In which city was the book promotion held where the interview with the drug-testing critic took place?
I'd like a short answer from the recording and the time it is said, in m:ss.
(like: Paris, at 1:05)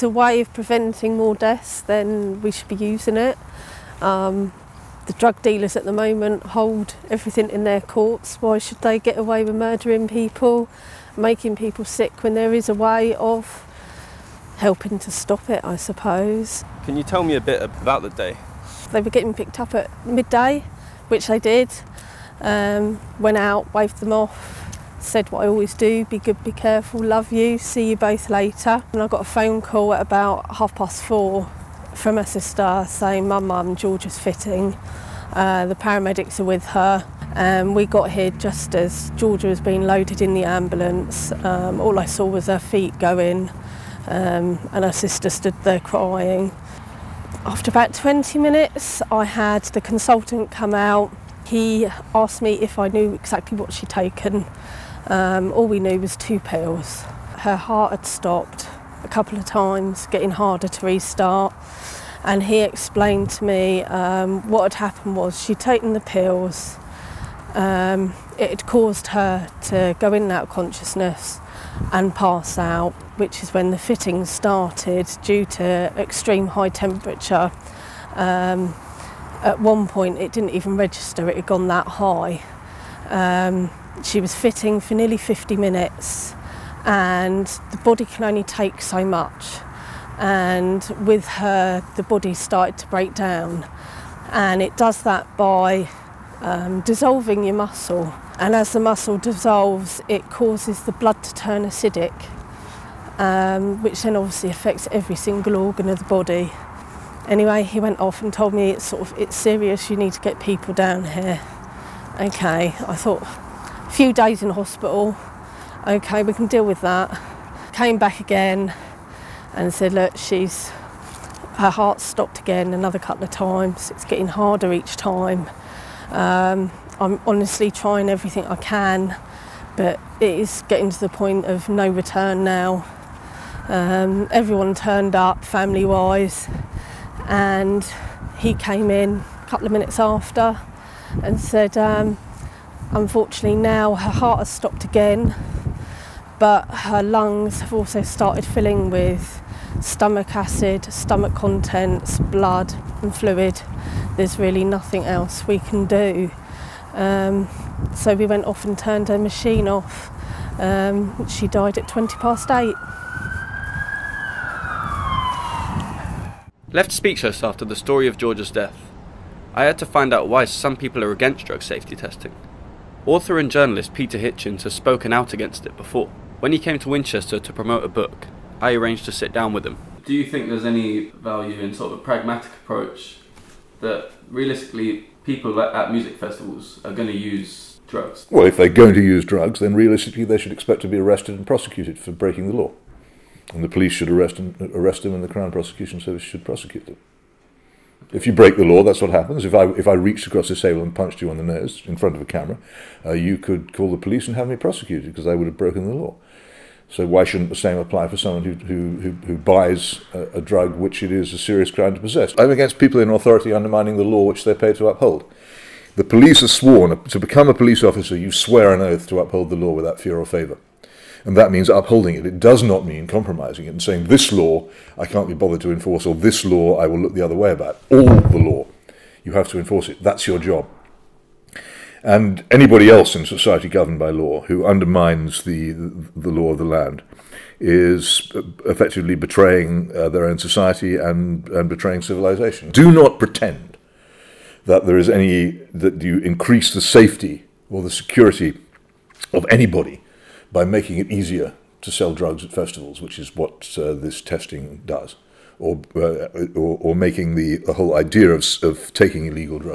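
Winchester, at 2:56.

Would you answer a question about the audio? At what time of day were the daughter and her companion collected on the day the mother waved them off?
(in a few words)
Midday.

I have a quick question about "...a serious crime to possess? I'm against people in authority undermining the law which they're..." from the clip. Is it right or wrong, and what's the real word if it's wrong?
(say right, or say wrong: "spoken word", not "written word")
right.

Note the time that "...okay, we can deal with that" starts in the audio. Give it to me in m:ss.
1:55.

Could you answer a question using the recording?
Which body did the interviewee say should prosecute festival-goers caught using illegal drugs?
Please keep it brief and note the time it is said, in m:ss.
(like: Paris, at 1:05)
Crown Prosecution Service, at 3:15.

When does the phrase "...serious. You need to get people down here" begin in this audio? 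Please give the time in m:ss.
1:49.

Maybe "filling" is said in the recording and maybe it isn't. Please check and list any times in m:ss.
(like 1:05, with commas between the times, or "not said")
2:28.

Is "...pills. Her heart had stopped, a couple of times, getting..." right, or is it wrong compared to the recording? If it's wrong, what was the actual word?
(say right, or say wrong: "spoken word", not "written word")
right.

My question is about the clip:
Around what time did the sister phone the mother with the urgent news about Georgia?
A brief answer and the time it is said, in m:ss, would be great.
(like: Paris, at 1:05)
Half past four, at 0:30.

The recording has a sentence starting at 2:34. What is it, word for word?
There's really nothing else we can do.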